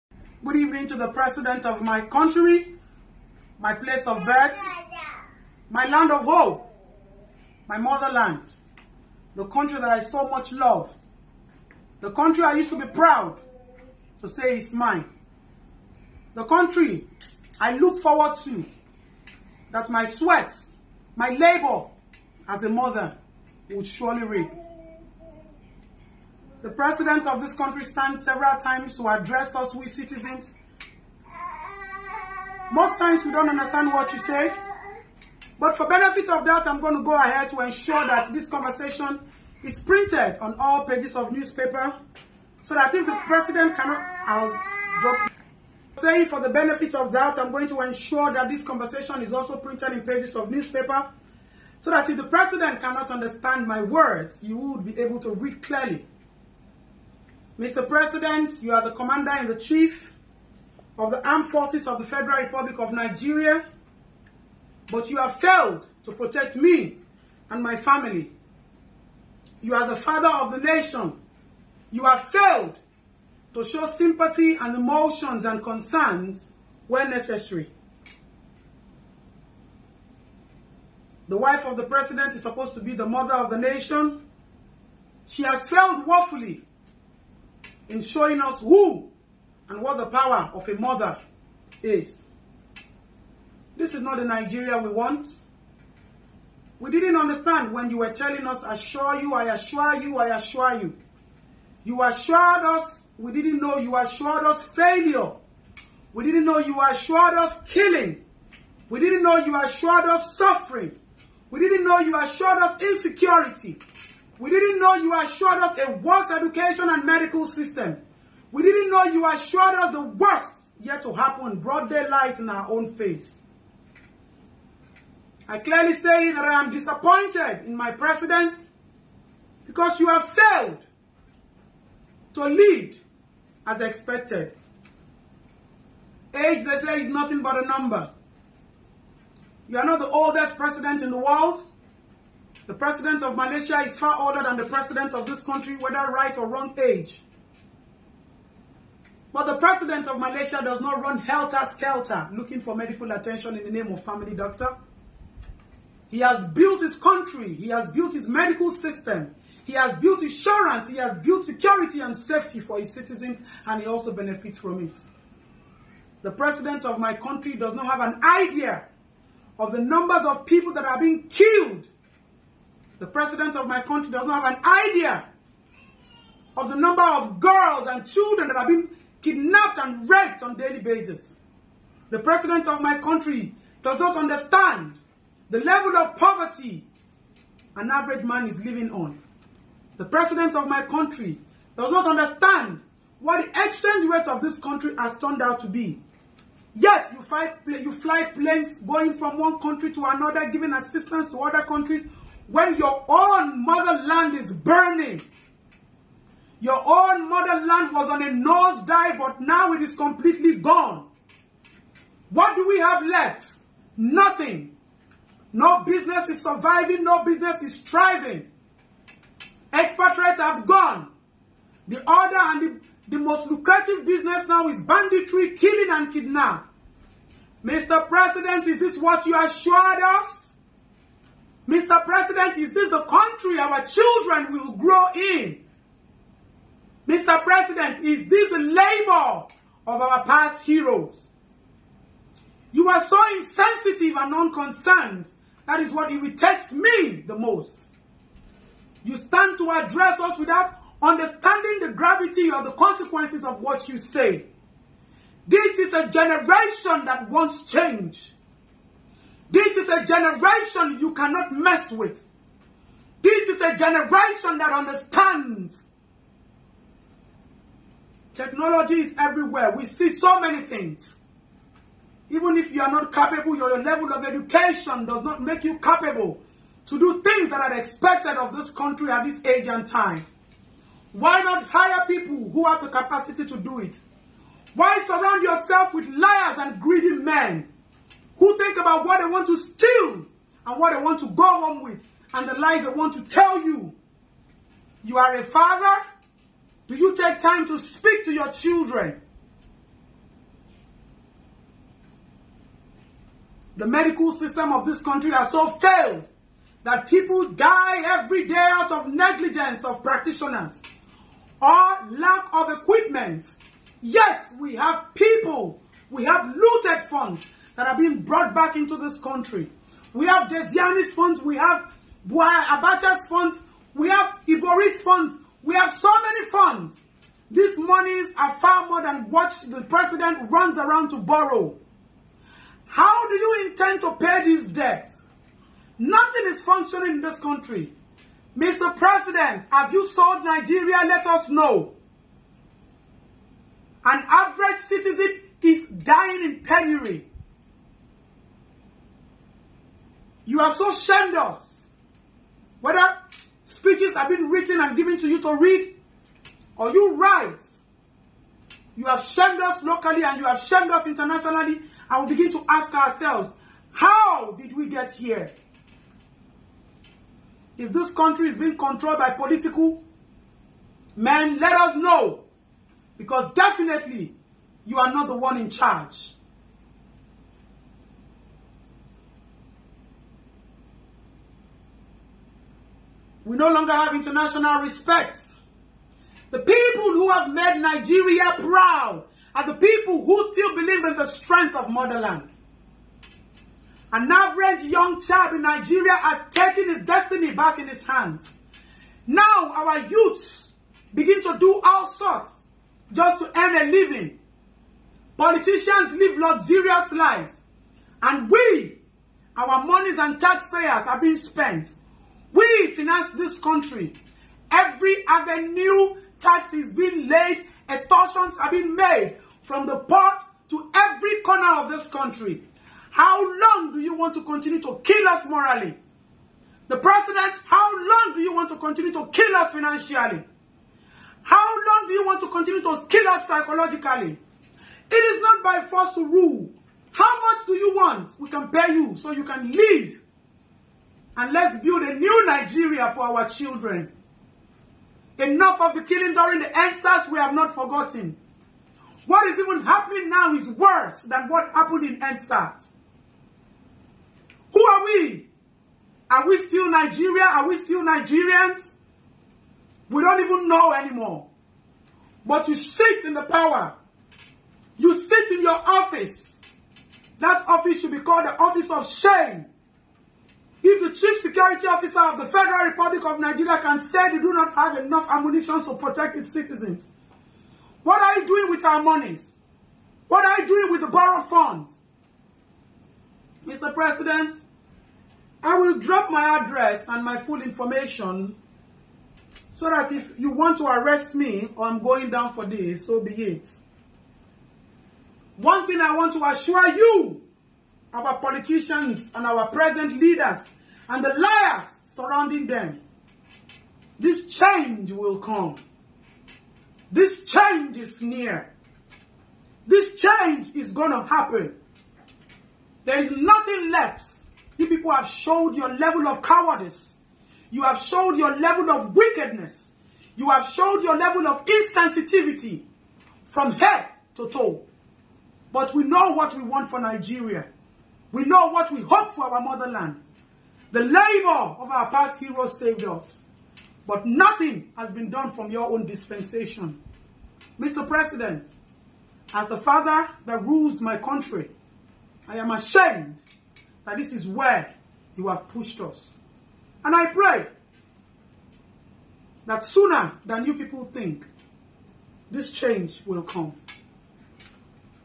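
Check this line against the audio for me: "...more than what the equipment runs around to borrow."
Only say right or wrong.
wrong.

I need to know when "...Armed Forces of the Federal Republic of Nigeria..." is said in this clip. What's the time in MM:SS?
01:01.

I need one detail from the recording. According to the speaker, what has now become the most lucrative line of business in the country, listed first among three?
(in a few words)
banditry.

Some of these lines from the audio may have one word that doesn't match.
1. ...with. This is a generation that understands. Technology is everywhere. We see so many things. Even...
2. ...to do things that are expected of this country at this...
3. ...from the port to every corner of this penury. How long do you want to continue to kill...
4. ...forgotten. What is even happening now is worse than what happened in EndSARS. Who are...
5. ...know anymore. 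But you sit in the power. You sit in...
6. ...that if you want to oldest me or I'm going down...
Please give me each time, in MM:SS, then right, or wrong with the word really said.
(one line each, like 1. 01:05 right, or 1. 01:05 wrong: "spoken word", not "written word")
1. 04:21 right
2. 04:36 right
3. 06:59 wrong: "country", not "penury"
4. 07:27 right
5. 07:40 right
6. 08:09 wrong: "arrest", not "oldest".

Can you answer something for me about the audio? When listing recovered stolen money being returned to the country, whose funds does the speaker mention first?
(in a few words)
Diezani.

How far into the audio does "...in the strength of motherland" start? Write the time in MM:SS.
06:31.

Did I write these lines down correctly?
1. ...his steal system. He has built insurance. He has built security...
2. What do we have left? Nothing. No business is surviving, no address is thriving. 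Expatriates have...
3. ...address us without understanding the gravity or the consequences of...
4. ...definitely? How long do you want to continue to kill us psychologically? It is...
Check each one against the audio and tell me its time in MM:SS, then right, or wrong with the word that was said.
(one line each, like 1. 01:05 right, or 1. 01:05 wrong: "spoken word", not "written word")
1. 02:38 wrong: "medical", not "steal"
2. 03:32 wrong: "business", not "address"
3. 04:09 right
4. 07:09 wrong: "financially", not "definitely".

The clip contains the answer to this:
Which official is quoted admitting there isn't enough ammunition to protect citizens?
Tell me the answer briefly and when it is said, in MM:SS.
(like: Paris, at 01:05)
chief security officer, at 07:51.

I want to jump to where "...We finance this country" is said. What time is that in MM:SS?
06:52.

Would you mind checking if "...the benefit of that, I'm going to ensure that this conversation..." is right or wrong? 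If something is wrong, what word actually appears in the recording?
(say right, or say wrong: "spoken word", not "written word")
right.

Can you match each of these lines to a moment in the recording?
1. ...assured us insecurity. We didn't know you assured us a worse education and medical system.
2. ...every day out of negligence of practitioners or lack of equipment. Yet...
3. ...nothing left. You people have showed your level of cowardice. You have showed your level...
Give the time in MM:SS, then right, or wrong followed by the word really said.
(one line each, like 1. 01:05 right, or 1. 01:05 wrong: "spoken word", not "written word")
1. 01:52 right
2. 05:08 right
3. 08:33 right.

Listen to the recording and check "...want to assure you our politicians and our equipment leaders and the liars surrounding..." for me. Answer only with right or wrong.
wrong.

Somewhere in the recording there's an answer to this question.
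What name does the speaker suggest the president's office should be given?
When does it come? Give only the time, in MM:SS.
07:48.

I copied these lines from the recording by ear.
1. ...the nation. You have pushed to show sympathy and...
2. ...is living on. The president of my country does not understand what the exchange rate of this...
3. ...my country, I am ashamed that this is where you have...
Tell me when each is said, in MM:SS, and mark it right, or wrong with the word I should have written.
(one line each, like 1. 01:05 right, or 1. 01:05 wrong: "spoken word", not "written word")
1. 01:10 wrong: "failed", not "pushed"
2. 03:08 right
3. 09:01 right.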